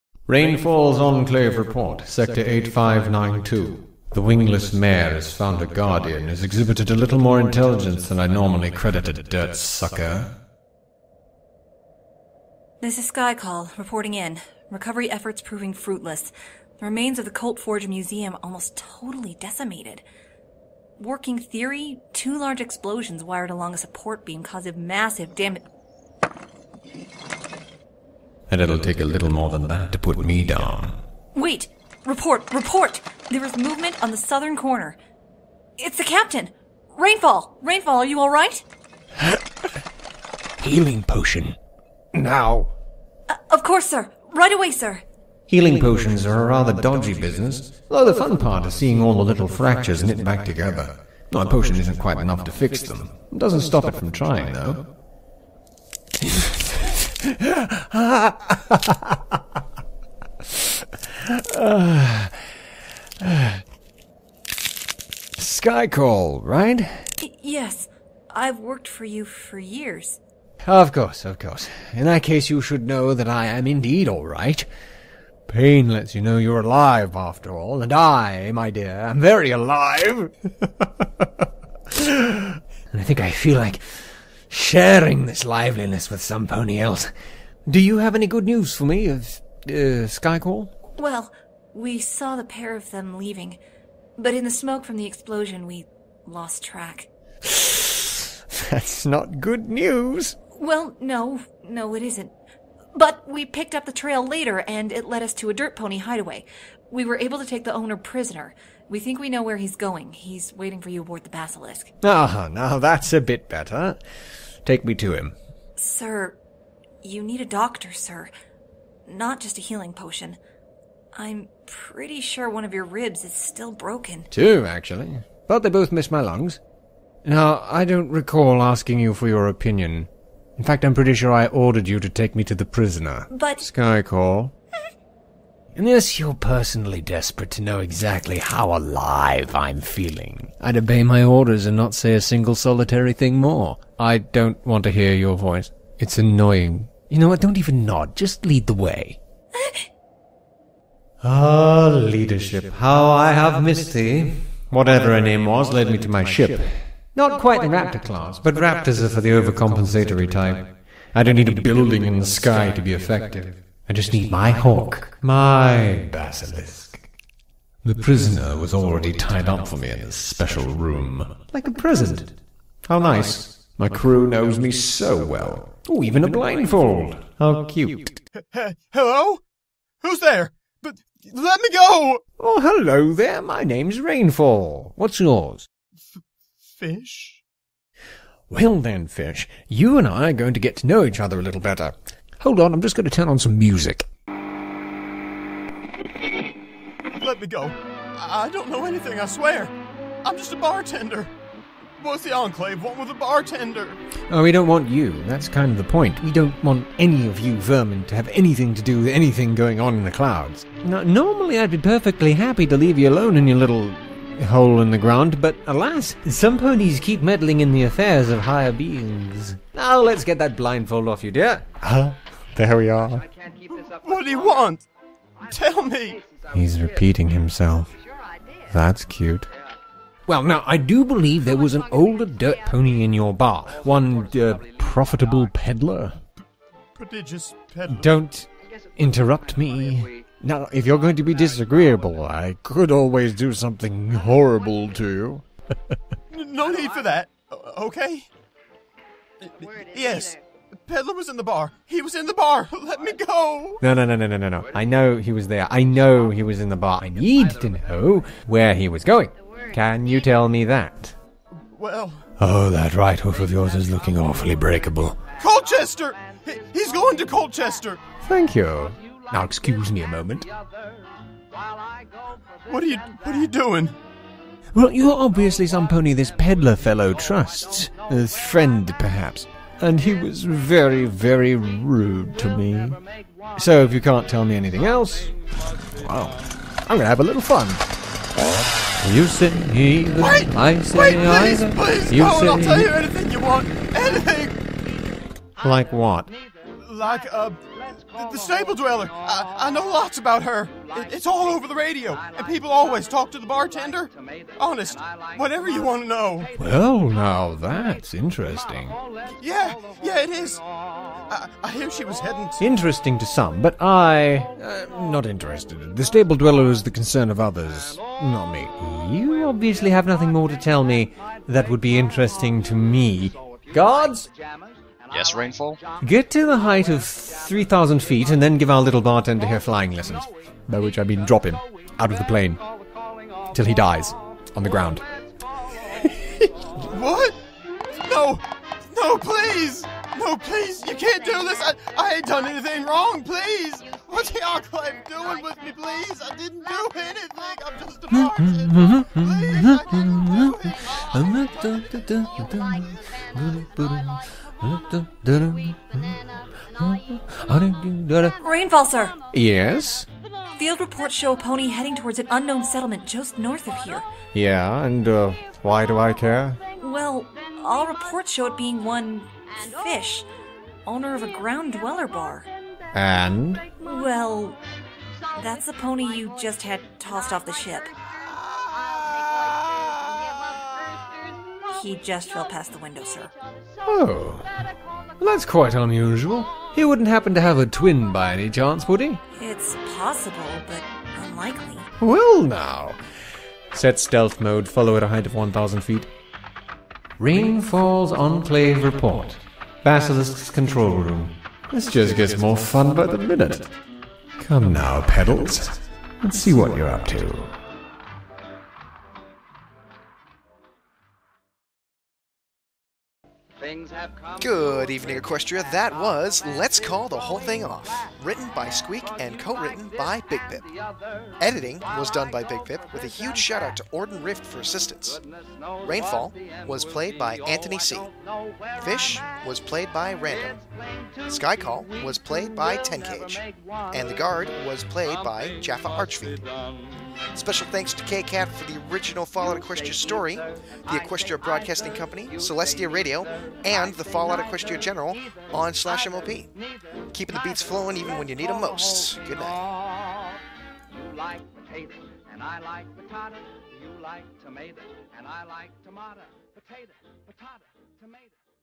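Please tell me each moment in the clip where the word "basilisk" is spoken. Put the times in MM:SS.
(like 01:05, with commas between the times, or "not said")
01:51, 02:46, 06:39.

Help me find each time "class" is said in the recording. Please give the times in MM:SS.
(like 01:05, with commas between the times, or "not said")
02:38.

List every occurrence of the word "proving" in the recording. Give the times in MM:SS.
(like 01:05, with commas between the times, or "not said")
00:15.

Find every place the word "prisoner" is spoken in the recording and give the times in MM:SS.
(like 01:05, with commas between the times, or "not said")
01:47, 02:12, 02:47.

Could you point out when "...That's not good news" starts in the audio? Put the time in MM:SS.
01:37.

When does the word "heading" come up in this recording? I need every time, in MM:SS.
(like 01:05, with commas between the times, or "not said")
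05:12, 06:01.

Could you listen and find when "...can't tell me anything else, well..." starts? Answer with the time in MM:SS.
04:44.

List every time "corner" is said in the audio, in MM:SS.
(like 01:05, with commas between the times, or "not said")
00:34.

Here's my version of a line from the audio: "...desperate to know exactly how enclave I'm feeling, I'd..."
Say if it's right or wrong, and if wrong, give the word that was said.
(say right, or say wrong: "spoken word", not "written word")
wrong: "alive", not "enclave".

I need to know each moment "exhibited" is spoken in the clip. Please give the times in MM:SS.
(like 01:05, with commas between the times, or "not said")
00:06.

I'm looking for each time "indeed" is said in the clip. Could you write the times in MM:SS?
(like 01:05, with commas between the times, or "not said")
01:13.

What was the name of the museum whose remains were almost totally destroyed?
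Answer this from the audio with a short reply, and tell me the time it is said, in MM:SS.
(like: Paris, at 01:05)
Coltforge Museum, at 00:17.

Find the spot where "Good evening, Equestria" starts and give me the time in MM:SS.
06:54.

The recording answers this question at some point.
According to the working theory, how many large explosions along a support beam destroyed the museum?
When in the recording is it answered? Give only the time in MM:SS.
00:22.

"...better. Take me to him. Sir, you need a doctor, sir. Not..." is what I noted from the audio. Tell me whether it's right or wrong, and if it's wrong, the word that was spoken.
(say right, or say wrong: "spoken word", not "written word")
right.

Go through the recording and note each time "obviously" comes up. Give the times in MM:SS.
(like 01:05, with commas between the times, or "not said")
04:35, 05:19.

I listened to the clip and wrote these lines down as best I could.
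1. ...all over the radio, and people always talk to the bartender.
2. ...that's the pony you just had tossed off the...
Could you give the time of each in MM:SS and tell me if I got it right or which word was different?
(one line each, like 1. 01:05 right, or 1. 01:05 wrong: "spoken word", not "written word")
1. 05:01 right
2. 06:15 right.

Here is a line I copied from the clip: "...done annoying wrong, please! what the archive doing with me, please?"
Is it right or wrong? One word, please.
wrong.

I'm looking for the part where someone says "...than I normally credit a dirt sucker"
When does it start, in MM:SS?
00:08.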